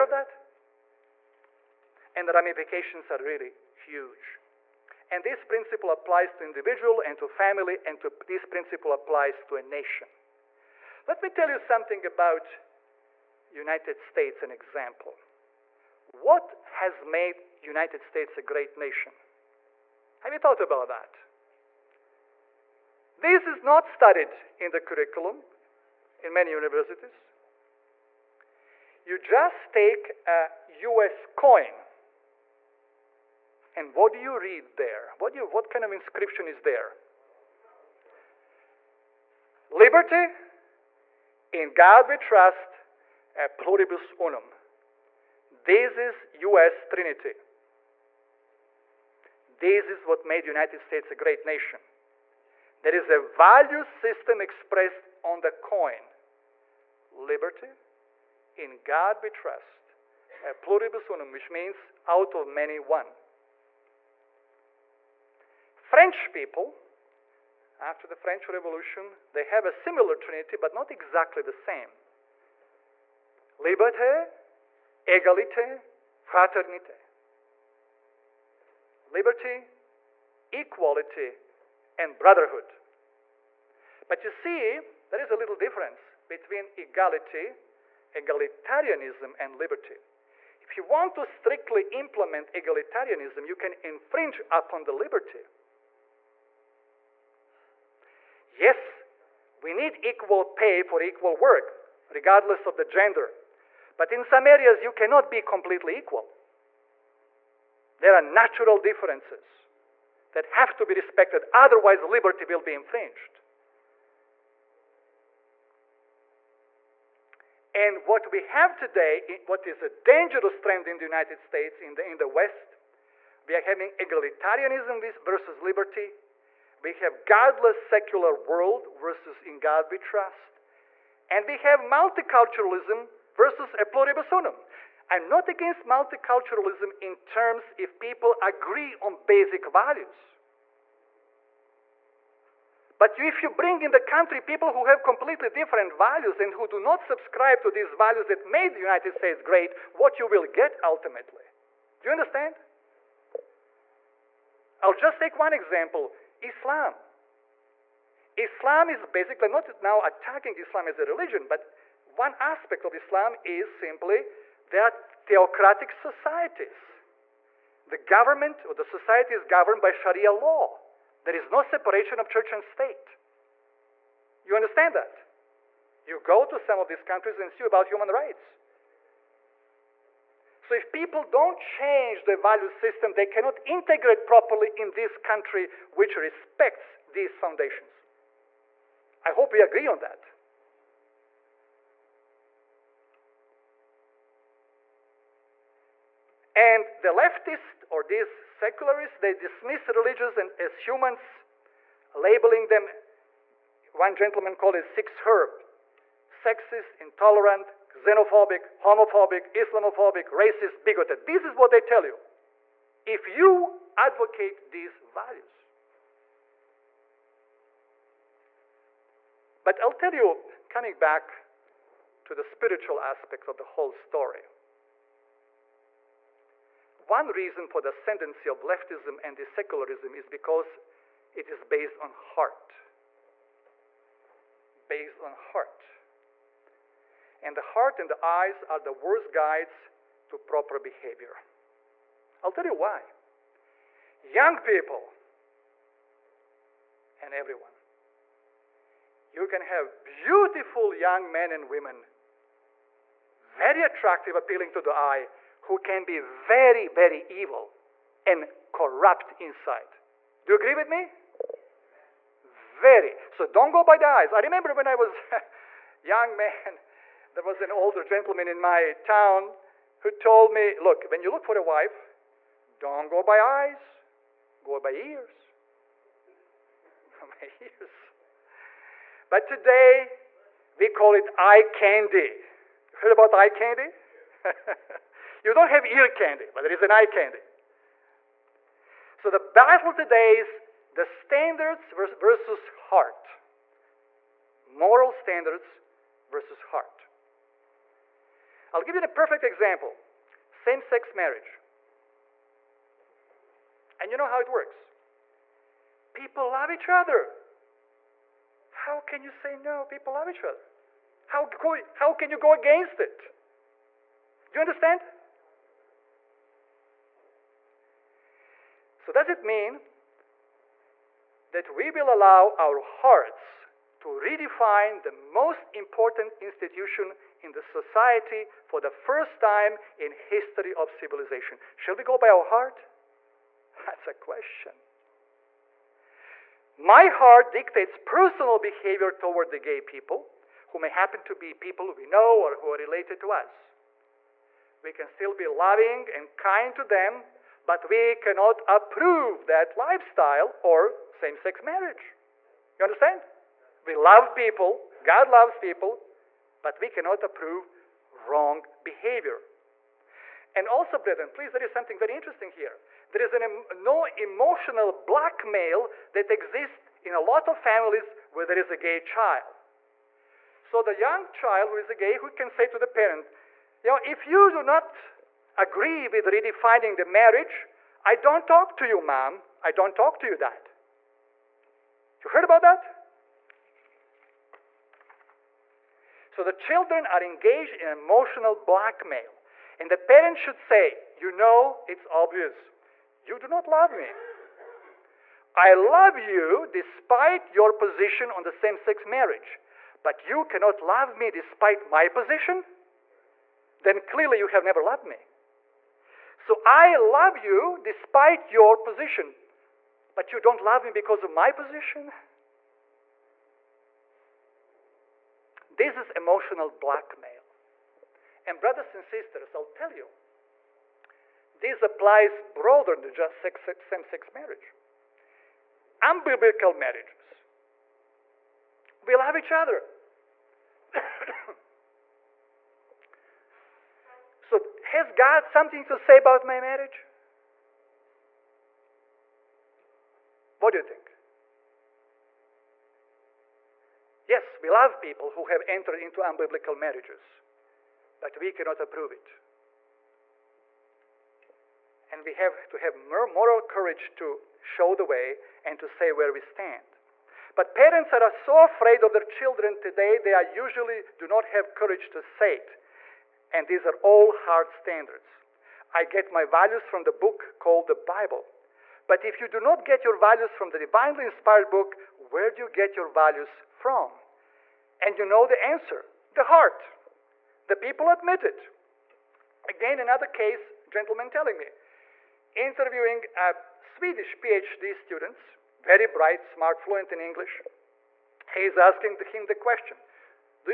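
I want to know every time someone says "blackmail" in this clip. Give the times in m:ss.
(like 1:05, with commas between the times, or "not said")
6:04, 6:28, 6:56.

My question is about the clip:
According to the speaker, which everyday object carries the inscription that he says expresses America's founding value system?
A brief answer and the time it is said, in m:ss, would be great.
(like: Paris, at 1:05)
US coin, at 0:30.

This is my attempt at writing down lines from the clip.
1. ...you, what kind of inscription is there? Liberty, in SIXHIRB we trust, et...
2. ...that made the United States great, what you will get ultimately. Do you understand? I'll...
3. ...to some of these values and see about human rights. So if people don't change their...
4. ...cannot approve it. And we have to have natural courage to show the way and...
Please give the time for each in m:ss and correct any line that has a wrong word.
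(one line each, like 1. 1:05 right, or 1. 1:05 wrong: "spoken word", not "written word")
1. 0:35 wrong: "God", not "SIXHIRB"
2. 2:28 right
3. 2:56 wrong: "countries", not "values"
4. 7:28 wrong: "moral", not "natural".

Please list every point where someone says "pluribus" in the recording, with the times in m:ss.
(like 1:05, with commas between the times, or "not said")
0:43, 1:00, 2:13.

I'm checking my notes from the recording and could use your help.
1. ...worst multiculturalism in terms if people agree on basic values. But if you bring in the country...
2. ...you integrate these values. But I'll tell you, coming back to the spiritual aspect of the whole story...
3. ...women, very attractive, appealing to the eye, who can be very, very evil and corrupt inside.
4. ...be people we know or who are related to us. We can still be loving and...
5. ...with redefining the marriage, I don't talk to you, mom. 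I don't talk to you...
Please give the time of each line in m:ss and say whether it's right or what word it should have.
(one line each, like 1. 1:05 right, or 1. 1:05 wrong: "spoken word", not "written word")
1. 2:15 wrong: "against", not "worst"
2. 3:33 wrong: "advocate", not "integrate"
3. 4:11 right
4. 5:41 right
5. 6:16 right.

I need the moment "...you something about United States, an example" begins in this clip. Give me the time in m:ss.
0:11.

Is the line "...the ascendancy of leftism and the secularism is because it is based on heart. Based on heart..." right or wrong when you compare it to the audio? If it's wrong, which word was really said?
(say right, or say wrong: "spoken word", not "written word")
right.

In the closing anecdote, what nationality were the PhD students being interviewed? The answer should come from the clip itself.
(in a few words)
Swedish.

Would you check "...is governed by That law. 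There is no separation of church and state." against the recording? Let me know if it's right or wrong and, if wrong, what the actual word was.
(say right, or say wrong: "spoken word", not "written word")
wrong: "Sharia", not "That".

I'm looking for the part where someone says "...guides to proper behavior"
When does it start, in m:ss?
3:59.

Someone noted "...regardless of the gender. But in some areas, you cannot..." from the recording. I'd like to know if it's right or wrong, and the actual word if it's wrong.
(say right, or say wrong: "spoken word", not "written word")
right.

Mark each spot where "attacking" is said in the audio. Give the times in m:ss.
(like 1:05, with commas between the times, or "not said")
2:40.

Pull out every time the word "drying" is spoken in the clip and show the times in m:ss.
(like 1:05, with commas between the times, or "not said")
not said.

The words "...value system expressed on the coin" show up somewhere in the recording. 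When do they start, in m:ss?
0:53.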